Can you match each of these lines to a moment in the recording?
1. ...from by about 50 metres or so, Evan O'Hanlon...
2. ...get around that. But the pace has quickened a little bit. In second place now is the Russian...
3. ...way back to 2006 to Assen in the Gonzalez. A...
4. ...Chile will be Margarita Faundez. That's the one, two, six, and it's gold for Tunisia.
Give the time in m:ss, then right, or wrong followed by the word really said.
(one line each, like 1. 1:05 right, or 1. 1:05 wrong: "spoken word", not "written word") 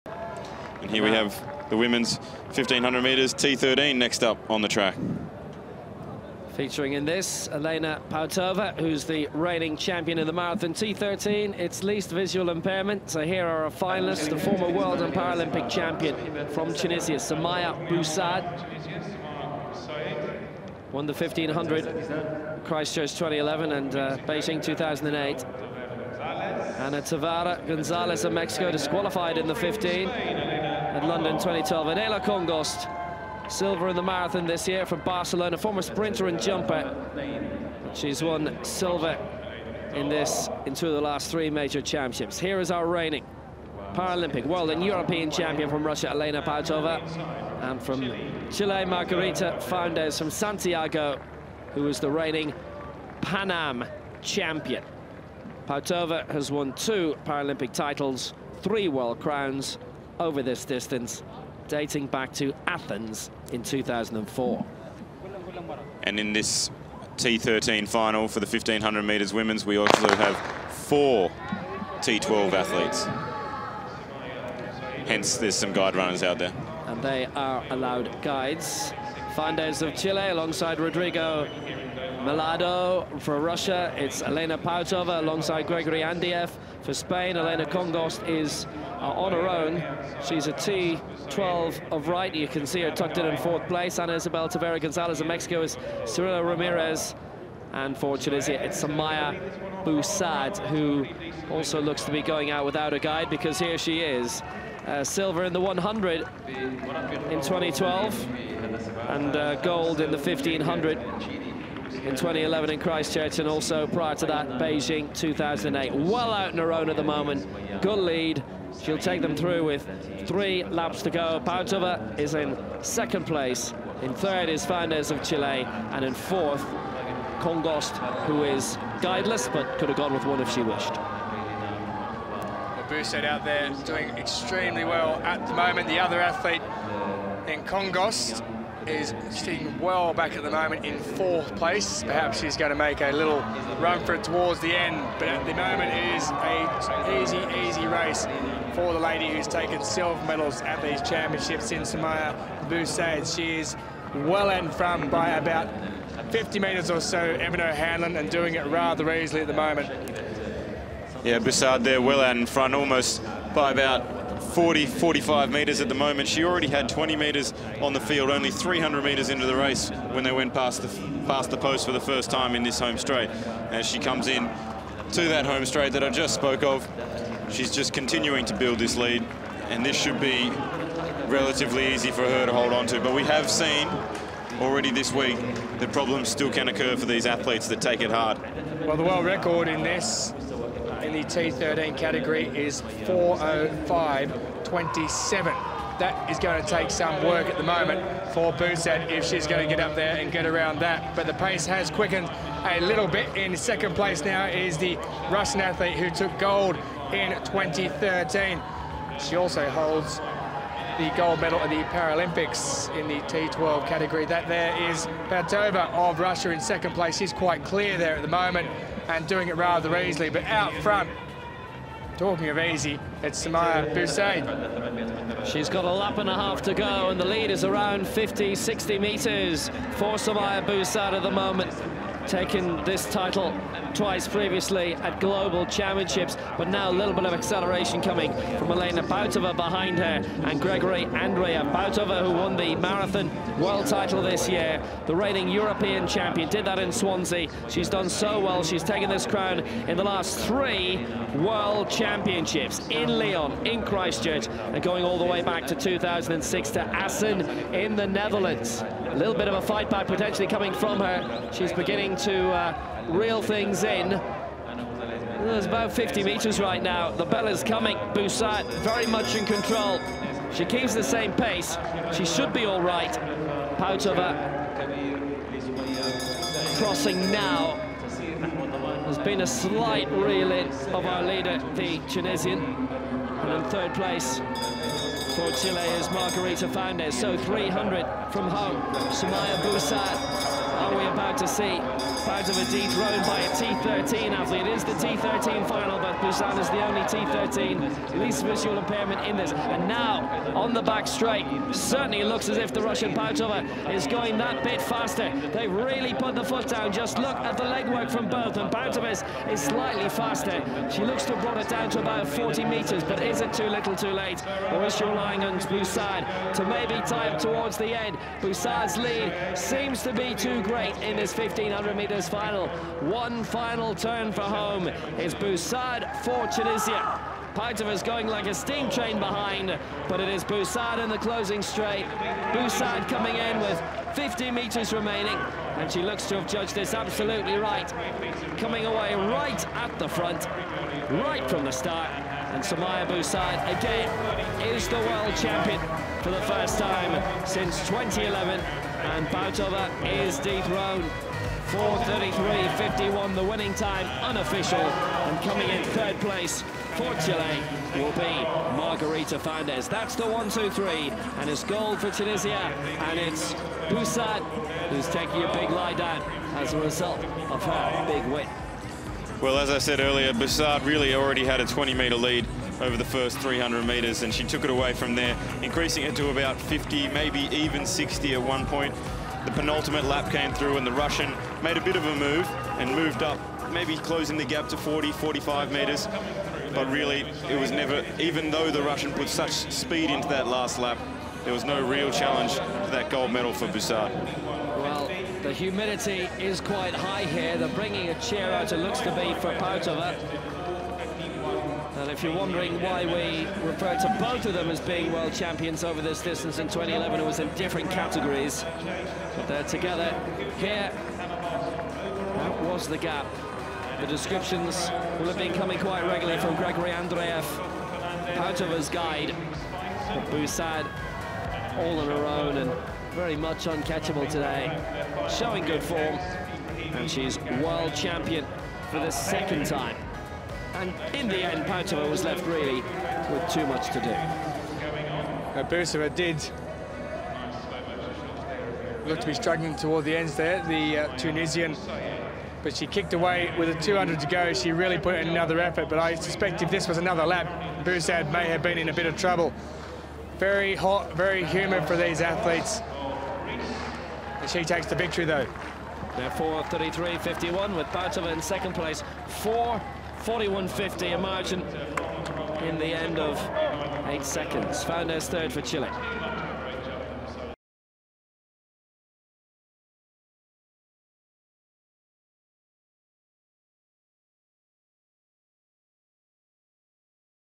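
1. 2:34 right
2. 3:20 right
3. 4:15 wrong: "Netherlands", not "Gonzalez"
4. 5:57 wrong: "three", not "six".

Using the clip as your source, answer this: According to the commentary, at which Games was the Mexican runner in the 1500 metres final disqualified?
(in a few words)
London 2012.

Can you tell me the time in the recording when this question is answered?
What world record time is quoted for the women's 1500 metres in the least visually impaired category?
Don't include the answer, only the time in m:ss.
3:13.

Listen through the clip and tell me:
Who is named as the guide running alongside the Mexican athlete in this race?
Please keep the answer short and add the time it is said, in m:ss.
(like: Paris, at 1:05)
Cirilo Ramirez, at 1:36.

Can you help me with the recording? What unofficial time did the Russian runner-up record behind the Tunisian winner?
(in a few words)
4:41.50.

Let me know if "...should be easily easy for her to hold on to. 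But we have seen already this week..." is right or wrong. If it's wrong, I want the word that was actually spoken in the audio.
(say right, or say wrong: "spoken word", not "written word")
wrong: "relatively", not "easily".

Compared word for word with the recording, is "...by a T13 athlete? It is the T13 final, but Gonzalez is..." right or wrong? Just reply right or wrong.
wrong.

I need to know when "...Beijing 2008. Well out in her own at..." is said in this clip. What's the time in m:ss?
1:54.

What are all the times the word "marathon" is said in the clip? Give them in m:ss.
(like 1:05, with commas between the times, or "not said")
0:10, 0:34, 4:02.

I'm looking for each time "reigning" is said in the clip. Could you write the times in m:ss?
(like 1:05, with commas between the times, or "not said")
0:09, 0:42, 0:52, 4:05.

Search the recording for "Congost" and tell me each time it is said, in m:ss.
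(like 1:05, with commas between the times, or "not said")
0:32, 1:27, 2:07, 2:17.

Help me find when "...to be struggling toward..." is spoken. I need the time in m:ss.
7:19.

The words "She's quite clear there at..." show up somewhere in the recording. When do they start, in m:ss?
3:37.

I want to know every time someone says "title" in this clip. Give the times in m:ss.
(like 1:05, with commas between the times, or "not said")
0:57, 3:53, 4:03.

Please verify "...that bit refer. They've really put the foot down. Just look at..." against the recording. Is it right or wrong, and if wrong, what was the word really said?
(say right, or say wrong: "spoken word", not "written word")
wrong: "faster", not "refer".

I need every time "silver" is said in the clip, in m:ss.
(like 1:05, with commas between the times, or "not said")
0:33, 0:38, 1:45, 2:29.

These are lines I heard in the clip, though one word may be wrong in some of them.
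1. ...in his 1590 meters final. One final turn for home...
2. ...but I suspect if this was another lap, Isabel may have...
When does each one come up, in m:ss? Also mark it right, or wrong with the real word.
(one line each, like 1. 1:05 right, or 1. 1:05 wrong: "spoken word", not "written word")
1. 5:21 wrong: "1500", not "1590"
2. 7:25 wrong: "Bousaid", not "Isabel".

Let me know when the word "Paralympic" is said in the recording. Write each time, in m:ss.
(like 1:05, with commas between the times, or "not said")
0:15, 0:43, 0:57, 3:31.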